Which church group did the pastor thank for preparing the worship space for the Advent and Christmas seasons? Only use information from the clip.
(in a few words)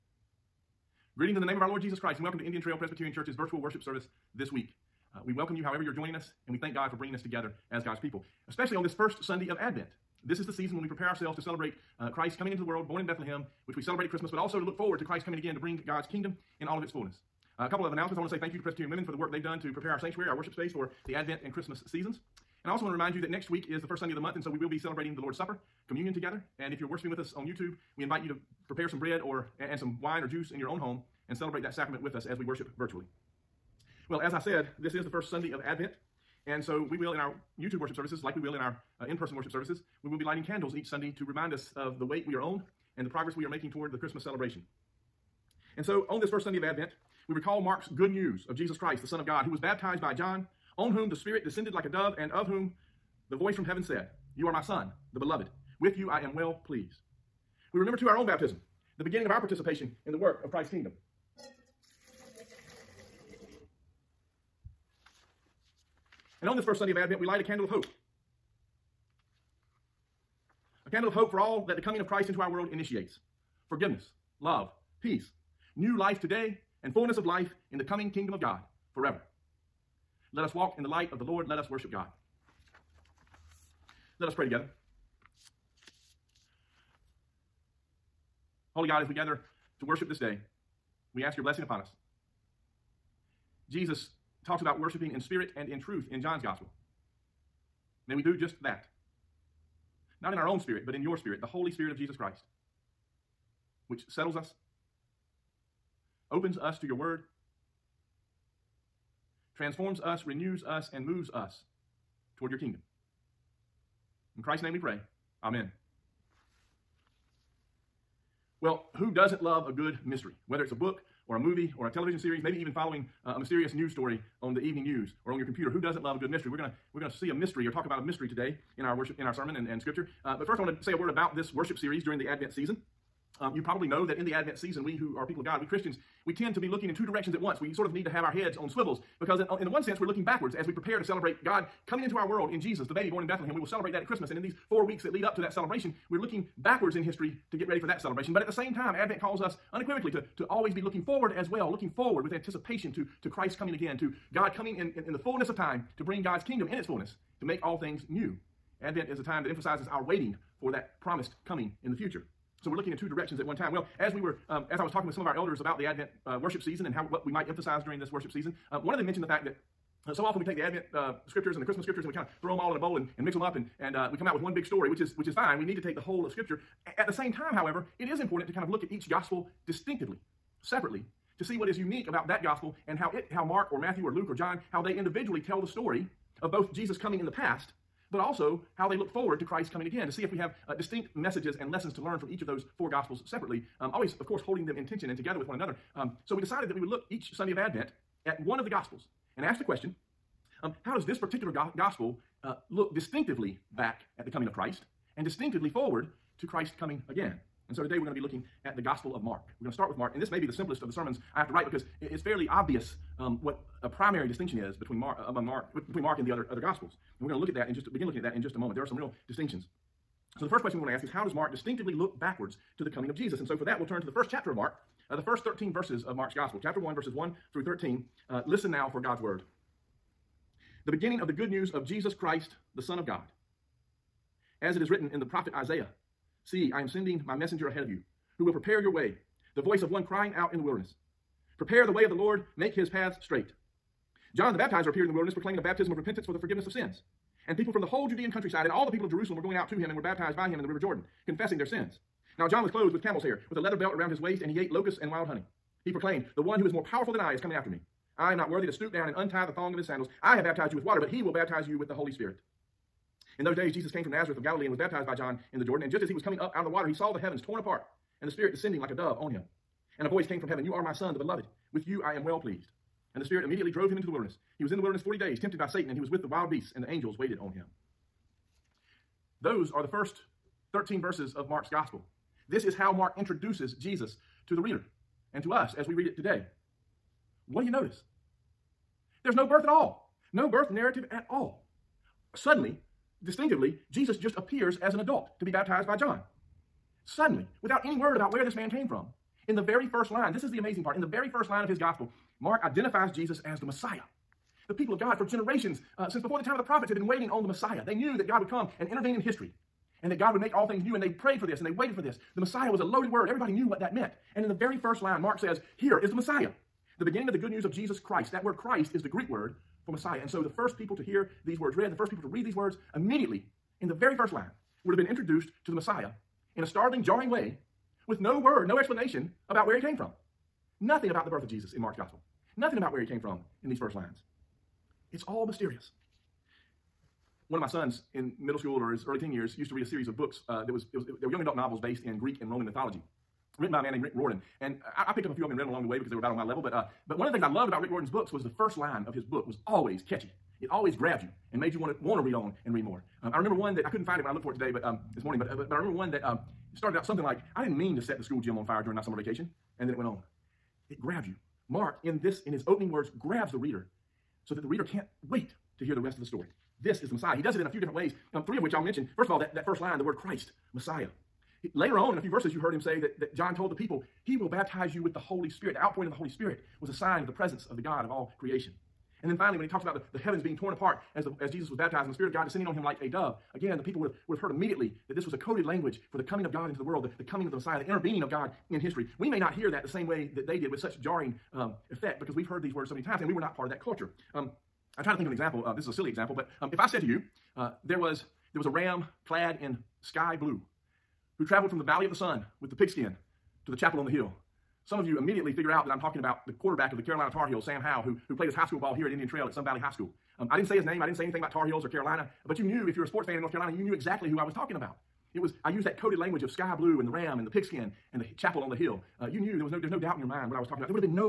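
Presbyterian Women.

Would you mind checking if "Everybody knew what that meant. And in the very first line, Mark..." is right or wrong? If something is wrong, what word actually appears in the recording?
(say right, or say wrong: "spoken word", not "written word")
right.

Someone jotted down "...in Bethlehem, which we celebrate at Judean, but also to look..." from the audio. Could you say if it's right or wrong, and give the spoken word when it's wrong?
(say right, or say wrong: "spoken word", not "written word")
wrong: "Christmas", not "Judean".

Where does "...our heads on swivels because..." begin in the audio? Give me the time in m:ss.
2:18.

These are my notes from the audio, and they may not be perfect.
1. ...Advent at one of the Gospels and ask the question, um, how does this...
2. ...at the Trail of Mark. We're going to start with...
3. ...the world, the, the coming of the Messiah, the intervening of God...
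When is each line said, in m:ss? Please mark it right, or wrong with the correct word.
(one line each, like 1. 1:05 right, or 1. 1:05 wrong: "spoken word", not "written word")
1. 3:17 right
2. 3:28 wrong: "Gospel", not "Trail"
3. 6:26 right.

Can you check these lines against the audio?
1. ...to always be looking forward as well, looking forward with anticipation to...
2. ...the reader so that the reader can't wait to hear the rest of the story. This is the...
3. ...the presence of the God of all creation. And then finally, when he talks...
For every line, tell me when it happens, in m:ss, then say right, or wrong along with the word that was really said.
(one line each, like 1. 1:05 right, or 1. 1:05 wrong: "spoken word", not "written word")
1. 2:30 right
2. 6:03 right
3. 6:17 right.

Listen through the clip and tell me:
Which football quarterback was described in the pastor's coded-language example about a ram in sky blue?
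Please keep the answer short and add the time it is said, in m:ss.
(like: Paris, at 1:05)
Sam Howell, at 6:47.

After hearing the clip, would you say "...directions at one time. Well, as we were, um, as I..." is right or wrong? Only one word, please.
right.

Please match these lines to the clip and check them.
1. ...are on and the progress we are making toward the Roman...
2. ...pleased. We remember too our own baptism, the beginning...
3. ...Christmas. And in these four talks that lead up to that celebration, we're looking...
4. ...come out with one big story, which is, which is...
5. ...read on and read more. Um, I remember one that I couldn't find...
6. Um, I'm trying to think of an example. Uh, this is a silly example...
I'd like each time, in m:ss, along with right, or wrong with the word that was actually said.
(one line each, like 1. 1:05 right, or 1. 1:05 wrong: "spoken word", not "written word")
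1. 0:42 wrong: "Christmas", not "Roman"
2. 0:56 right
3. 2:24 wrong: "weeks", not "talks"
4. 2:54 right
5. 5:52 right
6. 6:34 right.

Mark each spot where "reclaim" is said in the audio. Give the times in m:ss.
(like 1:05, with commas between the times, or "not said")
not said.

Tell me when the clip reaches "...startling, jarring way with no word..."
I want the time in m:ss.
5:26.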